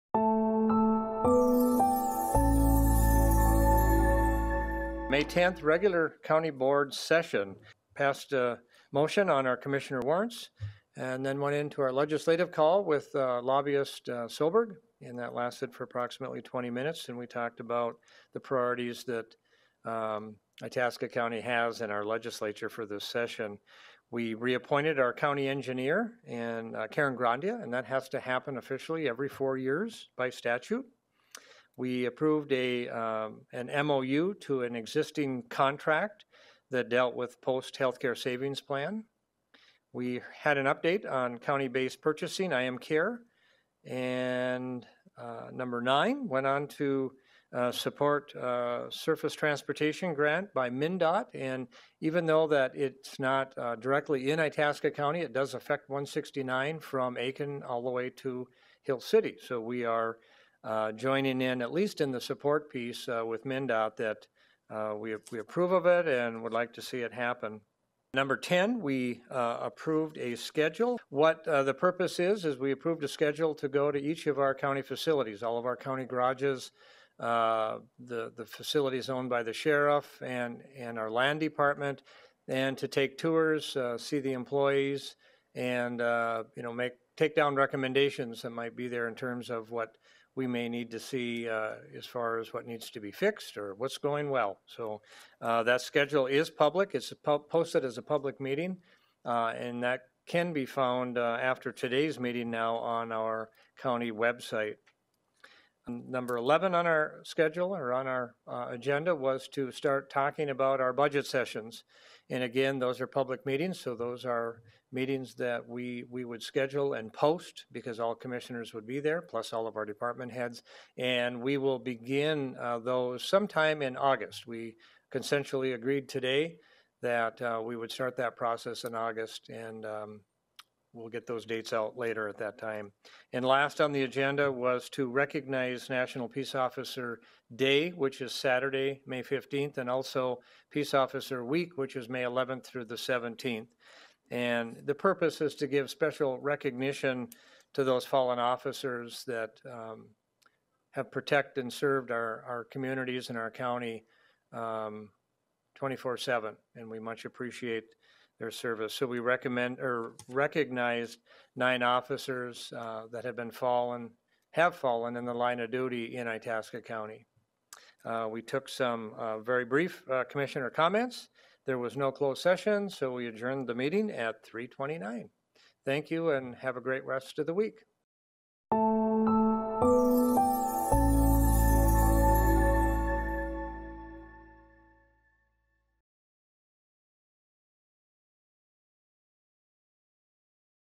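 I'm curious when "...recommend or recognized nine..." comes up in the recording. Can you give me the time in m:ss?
2:39.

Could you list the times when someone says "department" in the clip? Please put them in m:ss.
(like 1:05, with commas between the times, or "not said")
1:21, 1:59.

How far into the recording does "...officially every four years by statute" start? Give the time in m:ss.
0:28.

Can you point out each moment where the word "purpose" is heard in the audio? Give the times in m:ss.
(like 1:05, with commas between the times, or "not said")
1:11, 2:24.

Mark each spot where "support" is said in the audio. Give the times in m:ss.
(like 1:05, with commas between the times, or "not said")
0:47, 1:02.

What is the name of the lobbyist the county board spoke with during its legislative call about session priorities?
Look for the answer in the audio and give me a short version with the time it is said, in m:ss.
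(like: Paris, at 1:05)
Silberg, at 0:14.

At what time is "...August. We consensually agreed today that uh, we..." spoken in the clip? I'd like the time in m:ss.
2:03.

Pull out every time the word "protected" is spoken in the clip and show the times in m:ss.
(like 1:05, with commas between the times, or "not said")
2:31.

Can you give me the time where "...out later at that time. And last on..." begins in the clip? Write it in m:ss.
2:11.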